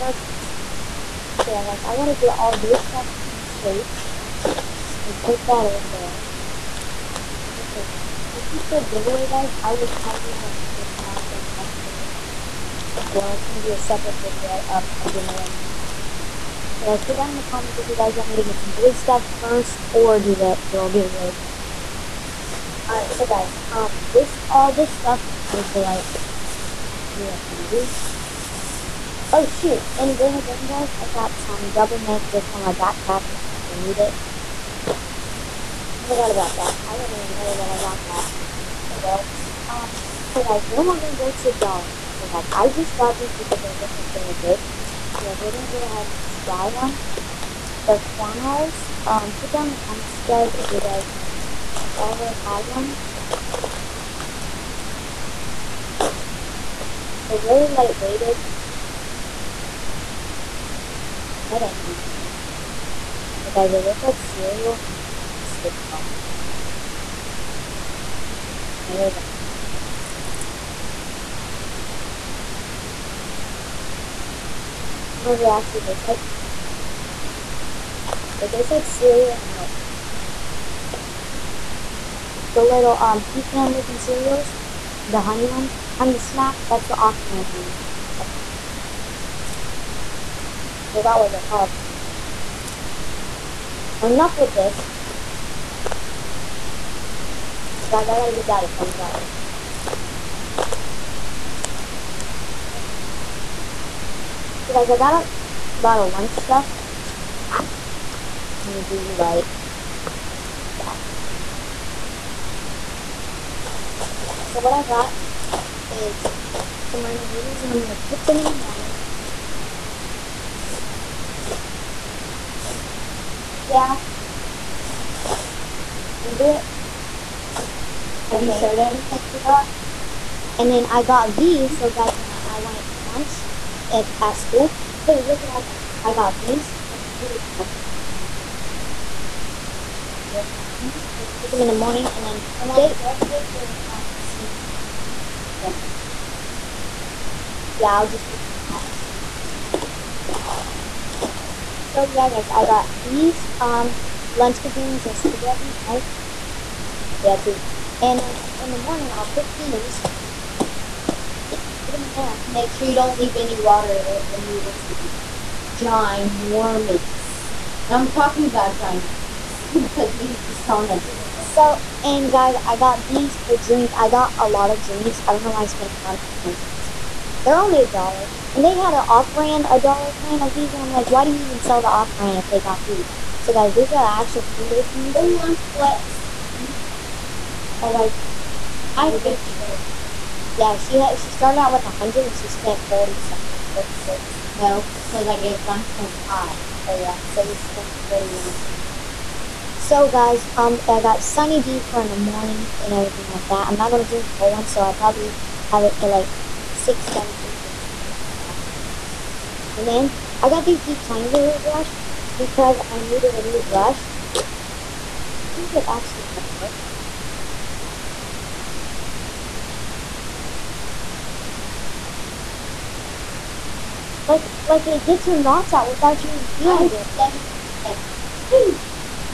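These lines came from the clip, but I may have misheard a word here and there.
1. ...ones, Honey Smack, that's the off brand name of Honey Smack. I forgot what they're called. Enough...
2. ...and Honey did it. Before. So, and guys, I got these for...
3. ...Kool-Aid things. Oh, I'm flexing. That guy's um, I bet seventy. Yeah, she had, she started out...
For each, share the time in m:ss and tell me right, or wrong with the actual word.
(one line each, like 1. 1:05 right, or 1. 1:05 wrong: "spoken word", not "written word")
1. 1:25 right
2. 2:50 wrong: "Christana", not "Honey"
3. 3:04 wrong: "fifty", not "seventy".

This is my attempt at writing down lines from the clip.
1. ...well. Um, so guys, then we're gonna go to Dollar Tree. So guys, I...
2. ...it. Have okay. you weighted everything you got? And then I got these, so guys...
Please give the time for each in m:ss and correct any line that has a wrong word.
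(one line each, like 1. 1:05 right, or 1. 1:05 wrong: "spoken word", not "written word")
1. 0:39 right
2. 2:06 wrong: "showed", not "weighted".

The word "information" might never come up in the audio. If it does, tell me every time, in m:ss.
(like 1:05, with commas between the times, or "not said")
0:10.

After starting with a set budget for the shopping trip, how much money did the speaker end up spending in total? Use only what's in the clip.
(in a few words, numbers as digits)
41.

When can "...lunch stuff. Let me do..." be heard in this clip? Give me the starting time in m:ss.
1:46.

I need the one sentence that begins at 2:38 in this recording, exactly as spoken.
And then in the morning, I'll cook these, there.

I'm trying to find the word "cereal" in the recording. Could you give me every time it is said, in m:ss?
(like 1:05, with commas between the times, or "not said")
1:04, 1:18, 1:23.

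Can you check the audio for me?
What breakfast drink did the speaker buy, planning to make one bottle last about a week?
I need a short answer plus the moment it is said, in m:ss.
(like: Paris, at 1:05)
Sunny D, at 3:21.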